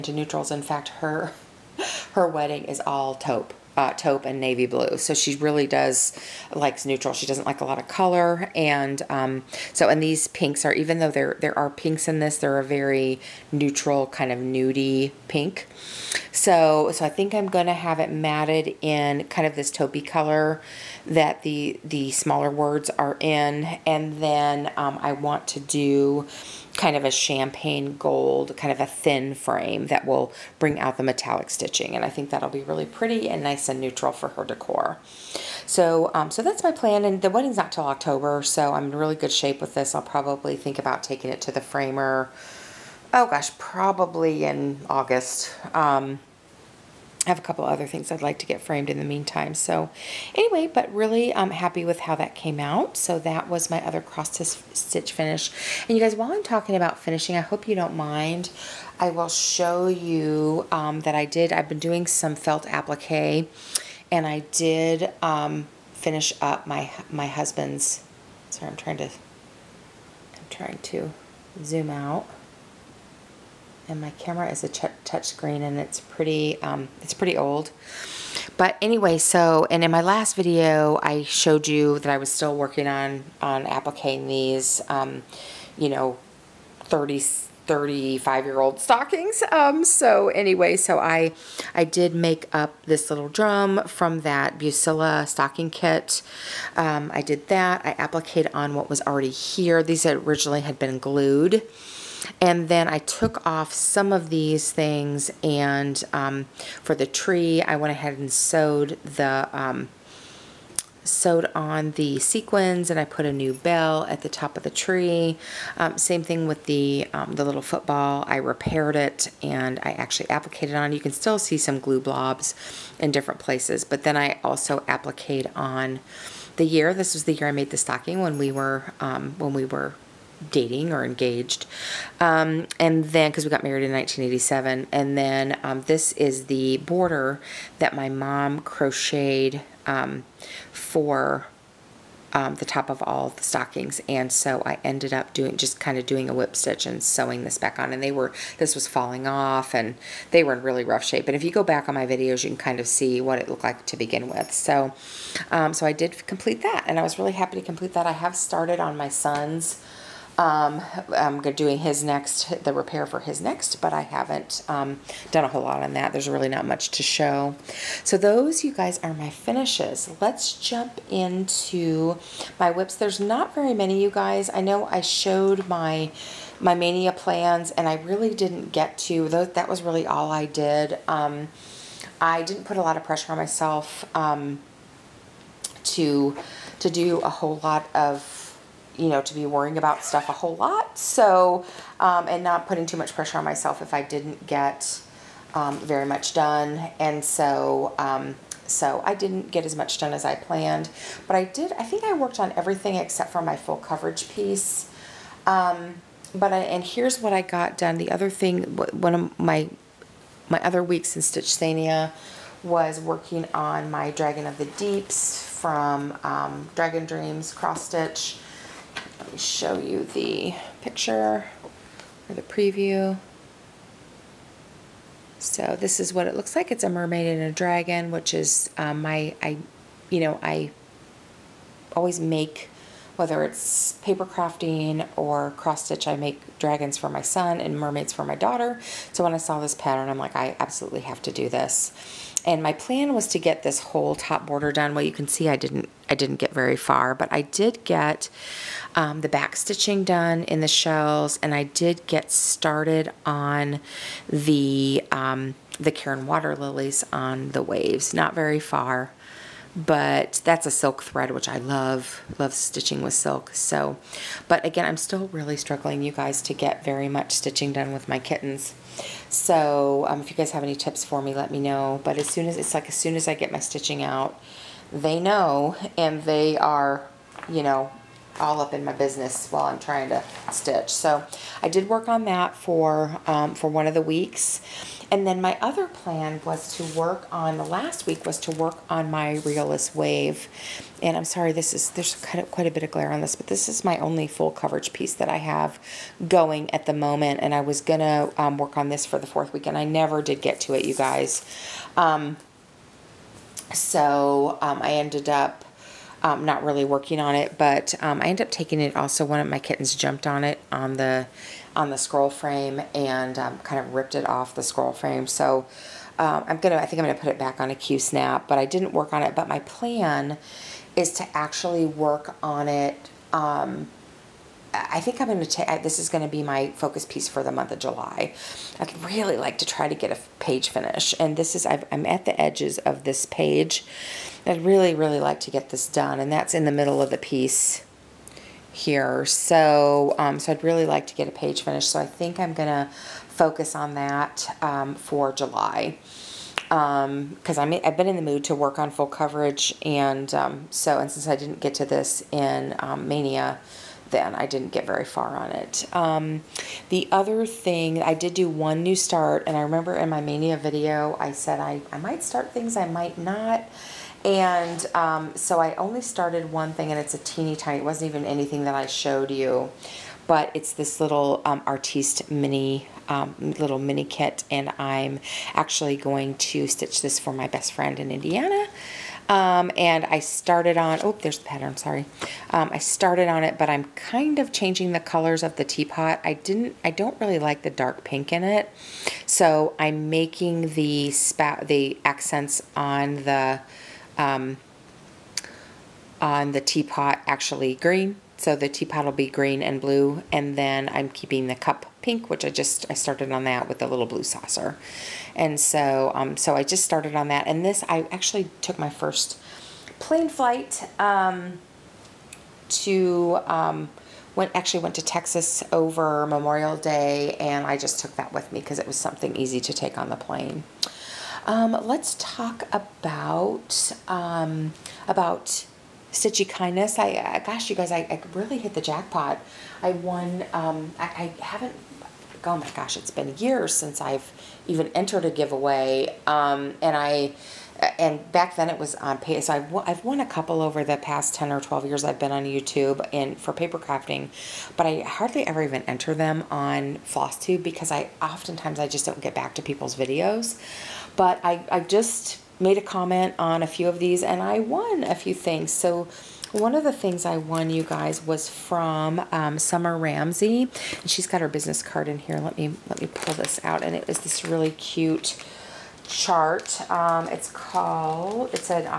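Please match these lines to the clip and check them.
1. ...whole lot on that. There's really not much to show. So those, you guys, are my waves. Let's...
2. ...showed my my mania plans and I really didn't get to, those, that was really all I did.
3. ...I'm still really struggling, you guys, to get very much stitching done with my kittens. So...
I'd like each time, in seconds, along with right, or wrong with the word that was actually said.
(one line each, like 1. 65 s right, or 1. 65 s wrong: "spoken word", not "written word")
1. 165 s wrong: "finishes", not "waves"
2. 175 s right
3. 264 s right.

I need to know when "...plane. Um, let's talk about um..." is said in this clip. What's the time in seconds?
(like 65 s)
420 s.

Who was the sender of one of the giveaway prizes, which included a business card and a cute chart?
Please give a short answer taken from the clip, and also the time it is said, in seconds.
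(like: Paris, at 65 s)
Summer Ramsey, at 459 s.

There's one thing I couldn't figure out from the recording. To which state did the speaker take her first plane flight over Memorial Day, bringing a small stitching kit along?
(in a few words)
Texas.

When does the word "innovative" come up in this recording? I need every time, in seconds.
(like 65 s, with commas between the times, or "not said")
not said.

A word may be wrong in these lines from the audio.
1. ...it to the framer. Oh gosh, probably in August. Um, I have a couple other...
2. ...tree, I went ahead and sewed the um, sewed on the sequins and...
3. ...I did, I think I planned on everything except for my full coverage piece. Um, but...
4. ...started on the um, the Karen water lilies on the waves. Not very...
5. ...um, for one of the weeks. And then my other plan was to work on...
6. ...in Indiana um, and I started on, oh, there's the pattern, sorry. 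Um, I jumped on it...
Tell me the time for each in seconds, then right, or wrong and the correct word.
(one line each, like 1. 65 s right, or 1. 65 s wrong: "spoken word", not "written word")
1. 41 s right
2. 107 s right
3. 201 s wrong: "worked", not "planned"
4. 252 s right
5. 283 s right
6. 378 s wrong: "started", not "jumped".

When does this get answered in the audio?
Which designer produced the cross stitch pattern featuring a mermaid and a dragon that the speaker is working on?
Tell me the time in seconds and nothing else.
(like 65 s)
216 s.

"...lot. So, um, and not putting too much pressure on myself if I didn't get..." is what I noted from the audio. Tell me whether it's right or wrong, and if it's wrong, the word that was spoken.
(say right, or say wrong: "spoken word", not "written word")
right.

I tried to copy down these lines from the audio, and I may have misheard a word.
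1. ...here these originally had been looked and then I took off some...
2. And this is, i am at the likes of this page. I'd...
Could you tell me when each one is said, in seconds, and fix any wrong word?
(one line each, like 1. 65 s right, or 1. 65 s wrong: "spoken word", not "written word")
1. 99 s wrong: "glued", not "looked"
2. 331 s wrong: "edges", not "likes".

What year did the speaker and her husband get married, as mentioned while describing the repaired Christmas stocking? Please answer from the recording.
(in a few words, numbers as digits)
1987.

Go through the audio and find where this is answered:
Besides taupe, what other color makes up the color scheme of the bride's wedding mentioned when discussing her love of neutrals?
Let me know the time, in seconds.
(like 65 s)
4 s.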